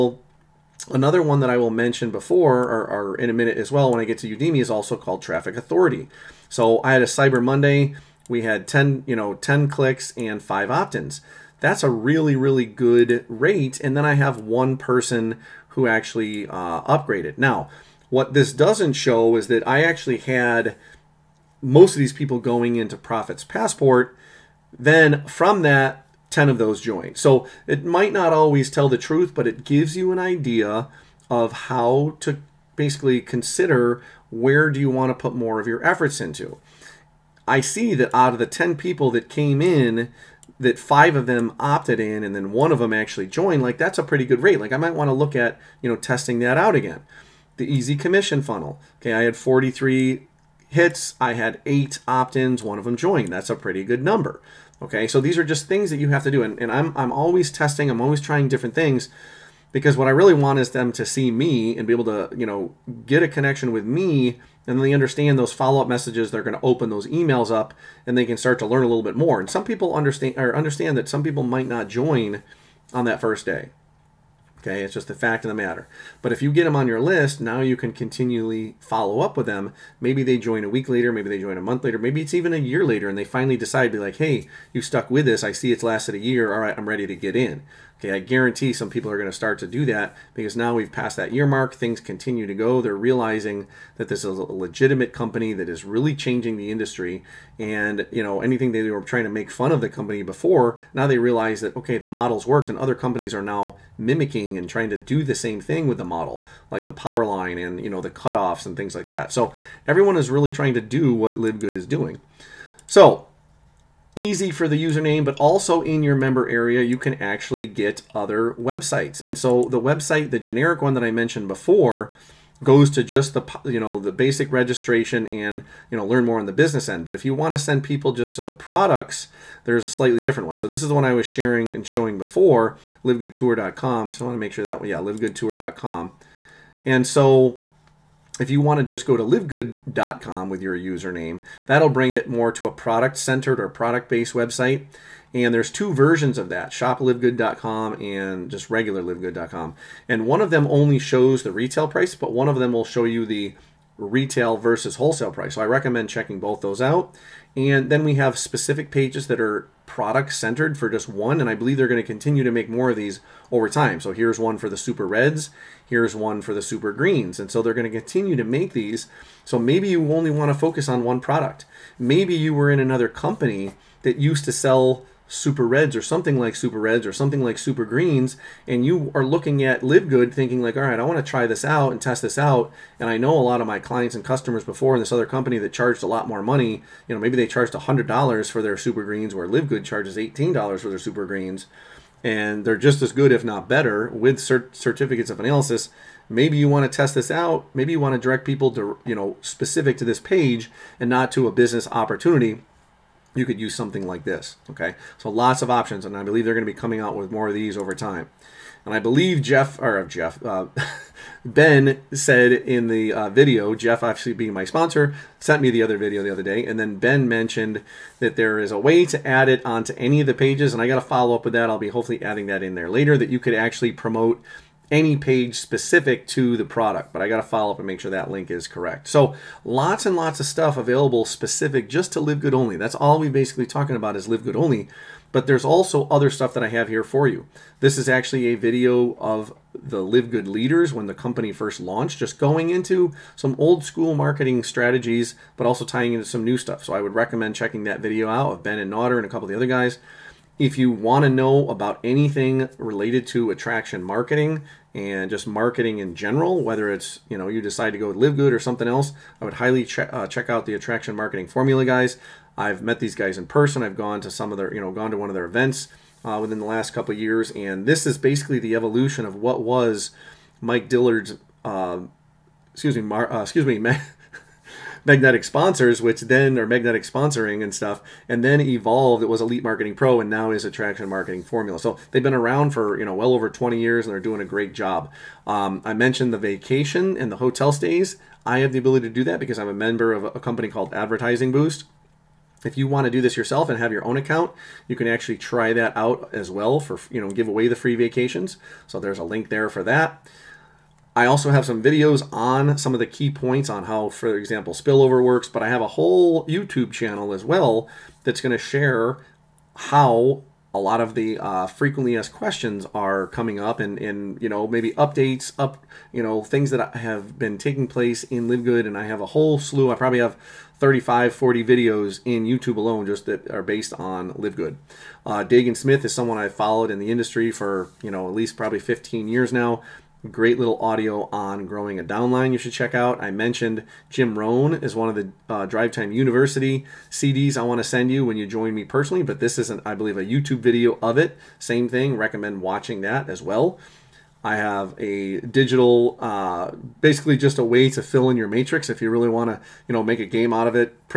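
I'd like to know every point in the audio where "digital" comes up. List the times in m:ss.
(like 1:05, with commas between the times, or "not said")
5:45.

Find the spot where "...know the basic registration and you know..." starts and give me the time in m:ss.
2:03.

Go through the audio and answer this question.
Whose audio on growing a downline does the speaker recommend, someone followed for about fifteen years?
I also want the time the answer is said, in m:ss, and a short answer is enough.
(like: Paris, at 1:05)
Dagan Smith, at 5:25.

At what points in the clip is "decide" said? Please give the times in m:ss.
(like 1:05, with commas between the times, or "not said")
1:23, 4:17.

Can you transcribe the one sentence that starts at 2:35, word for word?
So I recommend checking both those out.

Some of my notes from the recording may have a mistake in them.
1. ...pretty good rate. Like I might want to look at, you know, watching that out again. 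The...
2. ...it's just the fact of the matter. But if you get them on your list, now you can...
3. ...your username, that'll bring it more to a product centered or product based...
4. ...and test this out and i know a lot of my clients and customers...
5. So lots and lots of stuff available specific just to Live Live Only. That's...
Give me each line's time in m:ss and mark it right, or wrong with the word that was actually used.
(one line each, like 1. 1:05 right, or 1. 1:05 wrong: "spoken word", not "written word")
1. 0:44 wrong: "testing", not "watching"
2. 1:14 right
3. 2:20 right
4. 3:01 right
5. 3:49 wrong: "Good", not "Live".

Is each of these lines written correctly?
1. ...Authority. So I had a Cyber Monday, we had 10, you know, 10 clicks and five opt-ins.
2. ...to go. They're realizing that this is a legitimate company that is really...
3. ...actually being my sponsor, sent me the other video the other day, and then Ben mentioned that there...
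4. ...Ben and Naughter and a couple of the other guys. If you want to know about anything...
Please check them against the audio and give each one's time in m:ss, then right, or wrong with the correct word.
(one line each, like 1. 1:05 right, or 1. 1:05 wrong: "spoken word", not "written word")
1. 0:05 right
2. 1:32 right
3. 3:34 right
4. 4:08 right.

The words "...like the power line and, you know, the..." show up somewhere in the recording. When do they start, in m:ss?
1:46.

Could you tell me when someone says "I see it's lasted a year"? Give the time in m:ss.
1:25.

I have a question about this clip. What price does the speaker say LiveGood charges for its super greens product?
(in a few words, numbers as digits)
$18.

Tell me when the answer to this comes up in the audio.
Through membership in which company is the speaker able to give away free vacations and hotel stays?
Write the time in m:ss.
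4:50.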